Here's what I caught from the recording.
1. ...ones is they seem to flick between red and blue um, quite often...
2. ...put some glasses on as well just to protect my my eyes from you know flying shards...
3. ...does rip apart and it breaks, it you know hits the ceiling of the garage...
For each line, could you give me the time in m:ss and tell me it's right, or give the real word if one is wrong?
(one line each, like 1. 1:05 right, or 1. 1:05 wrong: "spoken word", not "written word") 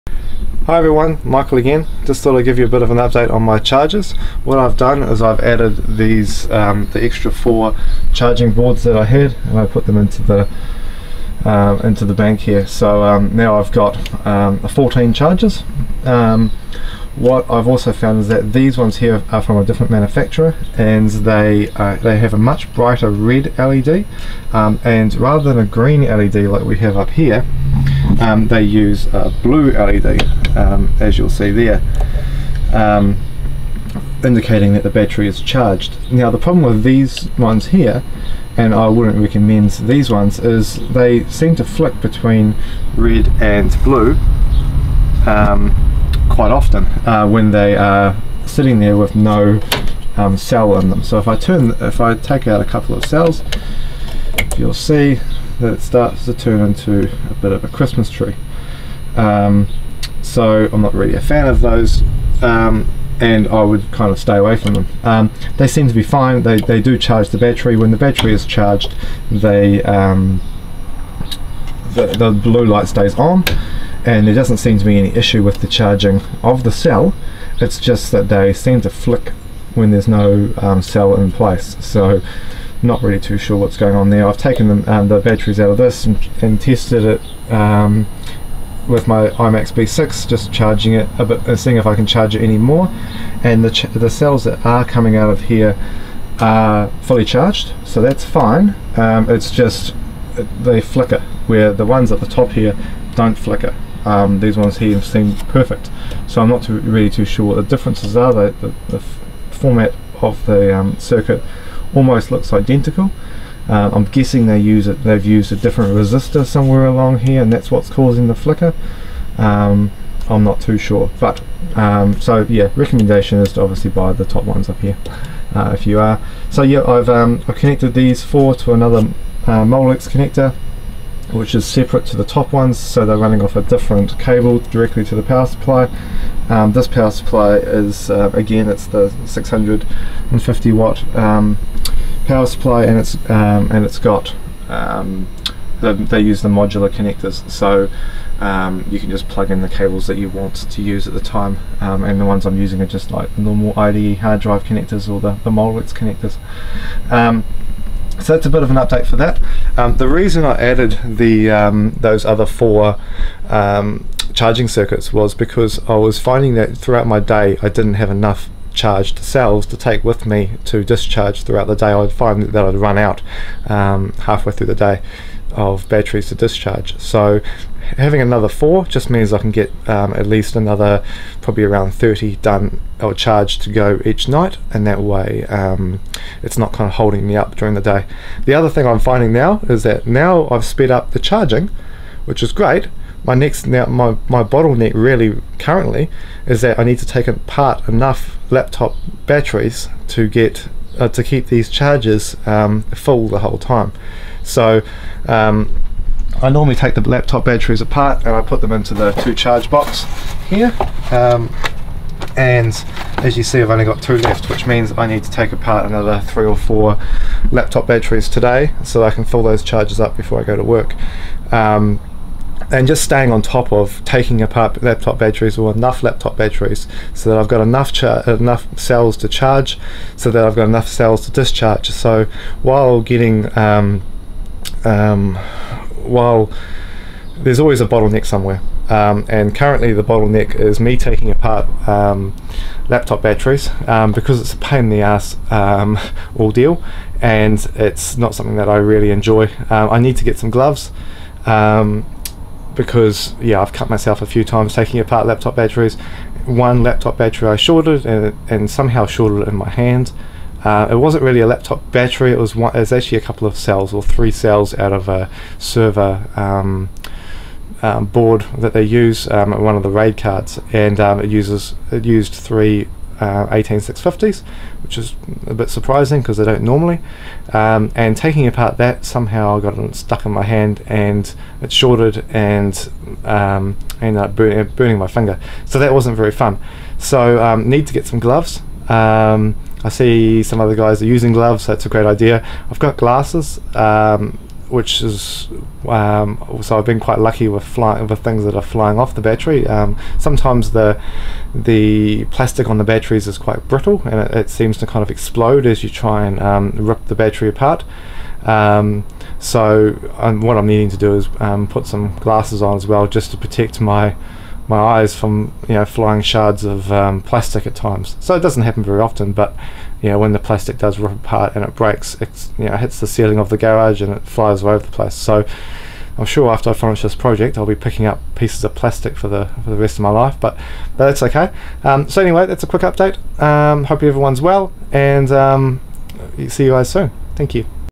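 1. 0:40 right
2. 5:11 right
3. 5:20 right.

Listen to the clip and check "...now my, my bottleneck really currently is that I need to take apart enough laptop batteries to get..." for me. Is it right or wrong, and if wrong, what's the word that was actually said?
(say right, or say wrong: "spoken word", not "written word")
right.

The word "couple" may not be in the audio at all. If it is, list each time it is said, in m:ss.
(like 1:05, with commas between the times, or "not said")
0:52, 4:23.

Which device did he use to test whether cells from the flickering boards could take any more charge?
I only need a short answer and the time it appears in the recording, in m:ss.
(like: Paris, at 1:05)
IMAX B6, at 1:29.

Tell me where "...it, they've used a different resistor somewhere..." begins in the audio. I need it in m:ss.
1:54.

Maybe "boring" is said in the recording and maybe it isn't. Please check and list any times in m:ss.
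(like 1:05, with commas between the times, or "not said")
not said.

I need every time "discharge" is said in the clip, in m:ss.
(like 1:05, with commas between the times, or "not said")
2:50, 2:56, 3:51.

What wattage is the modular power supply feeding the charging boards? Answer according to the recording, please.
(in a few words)
650 watt.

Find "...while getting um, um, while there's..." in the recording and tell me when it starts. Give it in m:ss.
3:52.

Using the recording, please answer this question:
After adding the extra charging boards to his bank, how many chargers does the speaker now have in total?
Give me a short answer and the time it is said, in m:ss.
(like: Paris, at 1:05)
14, at 0:14.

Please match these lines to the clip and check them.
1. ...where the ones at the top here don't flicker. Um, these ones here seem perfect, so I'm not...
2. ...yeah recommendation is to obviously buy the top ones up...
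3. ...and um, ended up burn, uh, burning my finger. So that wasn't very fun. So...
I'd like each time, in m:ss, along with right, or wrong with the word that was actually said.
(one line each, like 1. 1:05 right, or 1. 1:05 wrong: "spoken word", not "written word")
1. 1:41 right
2. 2:02 right
3. 4:42 right.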